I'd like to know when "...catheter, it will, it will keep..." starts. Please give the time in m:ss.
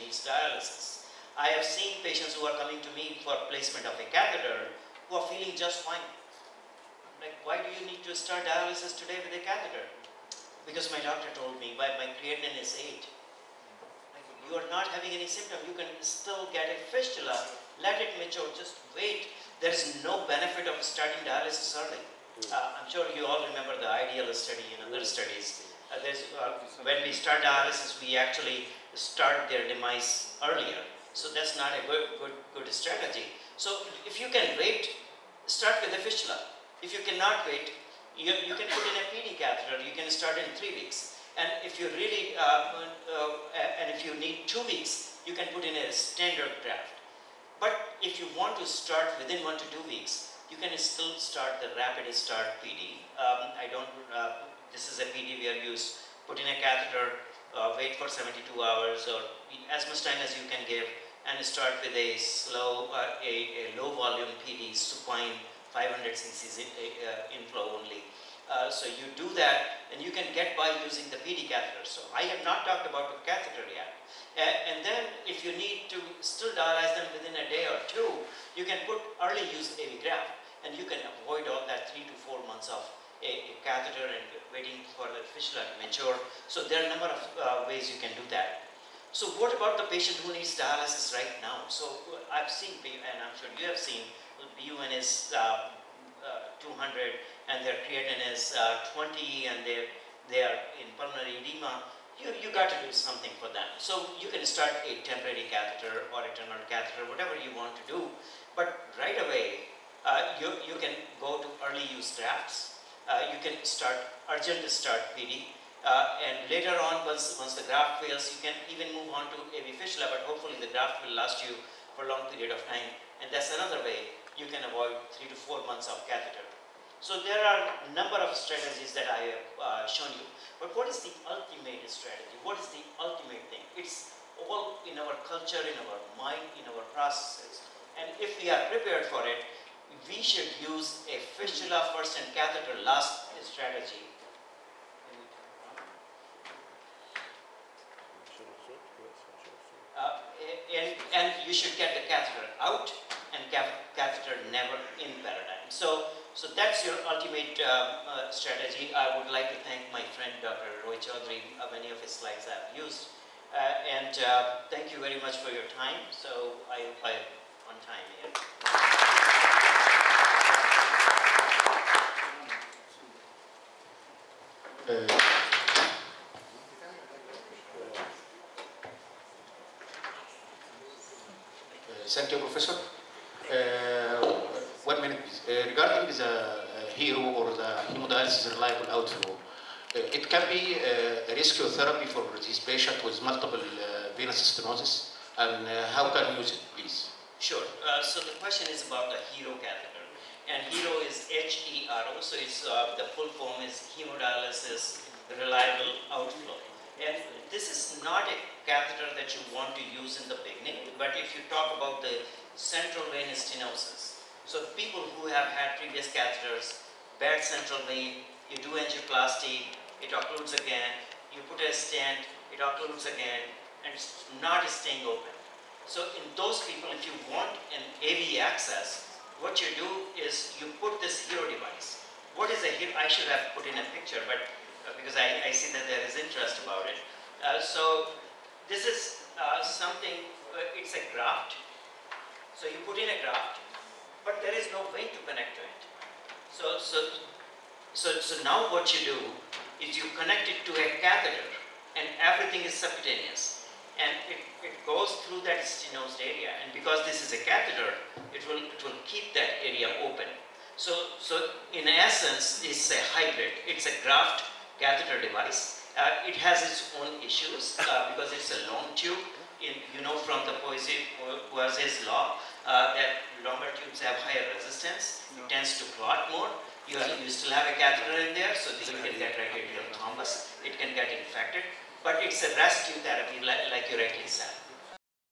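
4:17.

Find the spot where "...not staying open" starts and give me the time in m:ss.
3:44.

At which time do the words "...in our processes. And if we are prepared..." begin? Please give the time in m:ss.
2:16.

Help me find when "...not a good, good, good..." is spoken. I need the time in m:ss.
0:31.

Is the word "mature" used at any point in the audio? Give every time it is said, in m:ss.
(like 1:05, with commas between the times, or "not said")
0:18, 1:25.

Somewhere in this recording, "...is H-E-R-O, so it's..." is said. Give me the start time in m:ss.
3:21.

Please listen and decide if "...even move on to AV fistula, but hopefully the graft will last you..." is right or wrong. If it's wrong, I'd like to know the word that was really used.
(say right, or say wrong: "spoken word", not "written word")
right.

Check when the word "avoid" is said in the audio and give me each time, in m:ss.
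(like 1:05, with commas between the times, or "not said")
1:21, 2:04.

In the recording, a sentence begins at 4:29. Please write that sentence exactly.
In, you know from the Poiseuille's law uh, that longer tubes have higher resistance.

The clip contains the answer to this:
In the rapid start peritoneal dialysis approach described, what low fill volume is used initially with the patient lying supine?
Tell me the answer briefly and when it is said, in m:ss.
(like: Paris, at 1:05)
500 cc, at 1:05.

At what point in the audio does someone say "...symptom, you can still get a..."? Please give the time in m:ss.
0:15.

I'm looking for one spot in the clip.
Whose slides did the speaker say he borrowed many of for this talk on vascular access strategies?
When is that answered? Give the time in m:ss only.
2:40.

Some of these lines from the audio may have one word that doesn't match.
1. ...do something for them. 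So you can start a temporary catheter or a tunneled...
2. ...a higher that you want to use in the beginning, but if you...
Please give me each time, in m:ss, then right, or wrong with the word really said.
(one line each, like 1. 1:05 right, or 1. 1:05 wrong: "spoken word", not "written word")
1. 1:42 right
2. 3:28 wrong: "catheter", not "higher".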